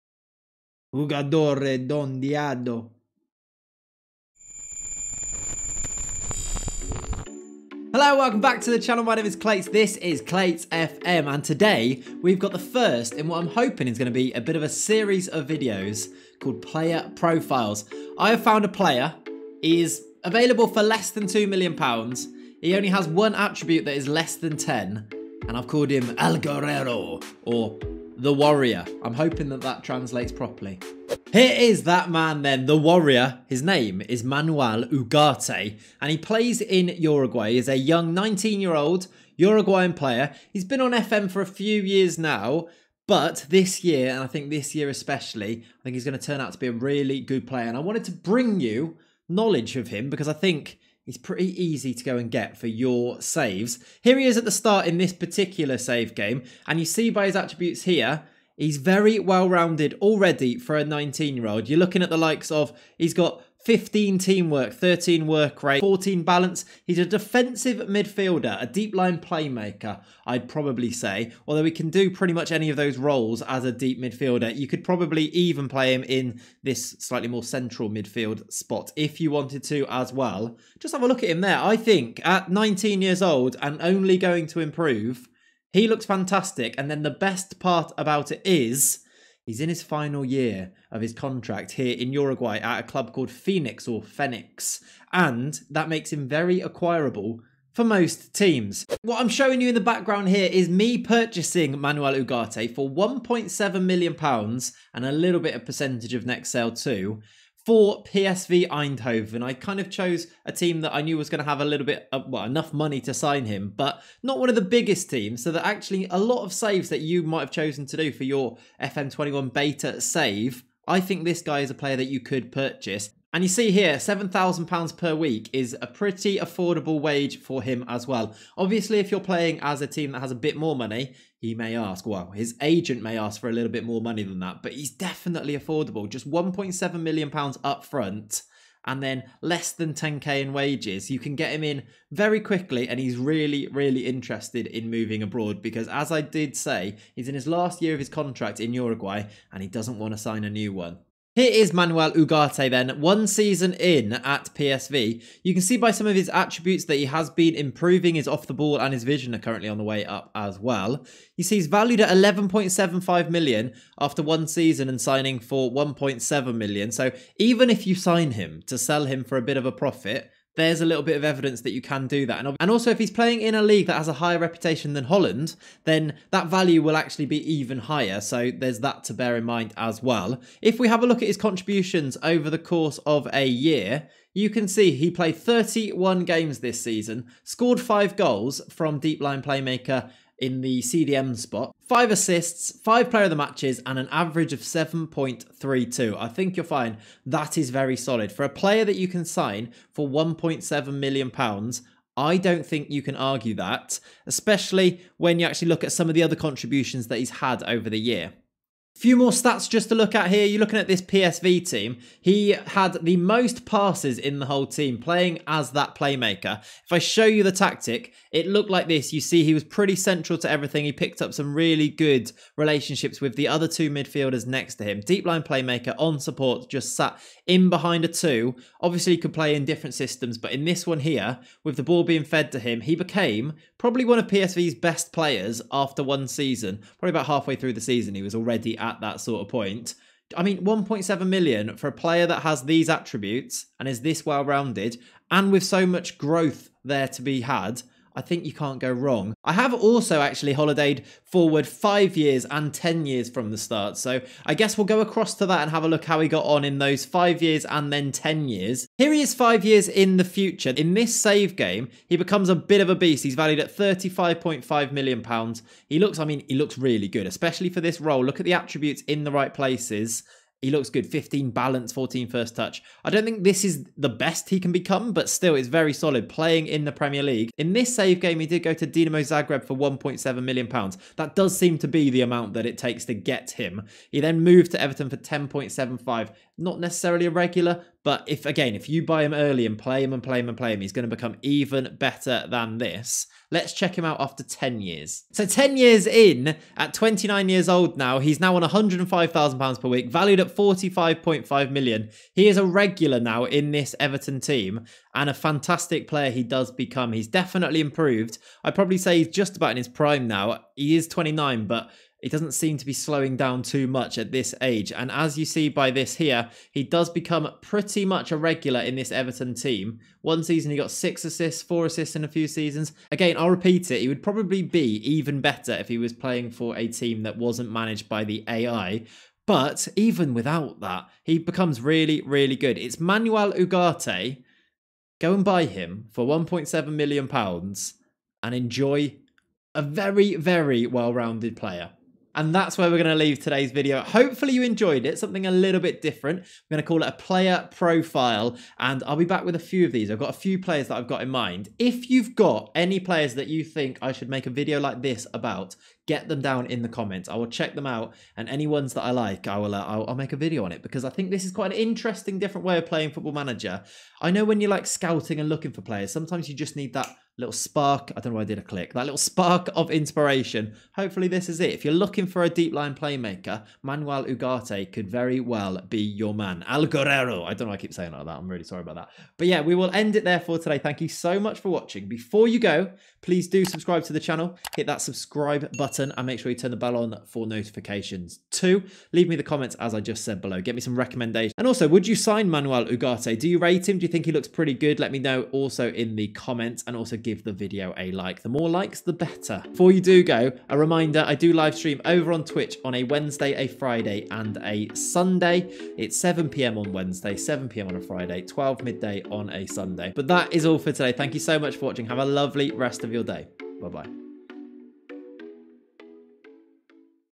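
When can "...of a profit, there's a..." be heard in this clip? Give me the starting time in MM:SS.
02:49.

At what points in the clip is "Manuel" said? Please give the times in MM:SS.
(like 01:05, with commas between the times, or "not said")
00:34, 01:41, 02:31, 05:32, 06:13, 06:32.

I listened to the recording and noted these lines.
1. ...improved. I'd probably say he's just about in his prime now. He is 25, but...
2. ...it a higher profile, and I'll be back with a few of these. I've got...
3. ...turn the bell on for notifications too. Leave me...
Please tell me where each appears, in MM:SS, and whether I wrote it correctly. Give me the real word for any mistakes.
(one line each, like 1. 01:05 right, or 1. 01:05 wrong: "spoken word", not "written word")
1. 05:07 wrong: "29", not "25"
2. 05:47 wrong: "player", not "higher"
3. 06:26 right.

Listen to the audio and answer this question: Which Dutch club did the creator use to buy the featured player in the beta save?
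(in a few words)
PSV Eindhoven.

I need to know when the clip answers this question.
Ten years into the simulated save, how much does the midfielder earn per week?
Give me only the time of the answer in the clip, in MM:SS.
04:58.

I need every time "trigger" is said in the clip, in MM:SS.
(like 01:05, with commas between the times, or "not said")
not said.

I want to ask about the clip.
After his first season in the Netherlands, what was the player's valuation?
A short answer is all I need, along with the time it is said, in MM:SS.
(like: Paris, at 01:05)
11.75 million, at 02:42.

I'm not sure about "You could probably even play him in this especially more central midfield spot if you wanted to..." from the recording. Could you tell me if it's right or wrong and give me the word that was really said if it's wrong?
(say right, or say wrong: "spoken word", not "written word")
wrong: "slightly", not "especially".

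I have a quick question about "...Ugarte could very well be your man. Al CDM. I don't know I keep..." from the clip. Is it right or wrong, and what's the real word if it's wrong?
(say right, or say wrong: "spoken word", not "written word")
wrong: "Guerrero", not "CDM".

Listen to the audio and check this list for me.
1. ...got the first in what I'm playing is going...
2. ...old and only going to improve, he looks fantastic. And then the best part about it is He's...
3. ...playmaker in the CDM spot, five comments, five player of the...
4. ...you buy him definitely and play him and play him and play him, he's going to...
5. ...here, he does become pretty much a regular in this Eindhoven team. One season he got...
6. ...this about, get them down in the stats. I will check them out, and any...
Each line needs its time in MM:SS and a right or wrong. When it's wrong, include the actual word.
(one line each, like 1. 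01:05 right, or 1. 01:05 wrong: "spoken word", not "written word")
1. 00:12 wrong: "hoping", not "playing"
2. 01:23 right
3. 03:09 wrong: "assists", not "comments"
4. 04:48 wrong: "early", not "definitely"
5. 05:16 wrong: "Everton", not "Eindhoven"
6. 05:55 wrong: "comments", not "stats".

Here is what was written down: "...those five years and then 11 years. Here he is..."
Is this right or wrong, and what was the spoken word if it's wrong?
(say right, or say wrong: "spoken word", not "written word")
wrong: "10", not "11".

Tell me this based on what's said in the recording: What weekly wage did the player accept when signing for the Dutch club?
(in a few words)
£7,000.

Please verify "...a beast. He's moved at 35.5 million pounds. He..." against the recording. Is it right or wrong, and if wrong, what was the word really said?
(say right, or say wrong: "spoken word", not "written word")
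wrong: "valued", not "moved".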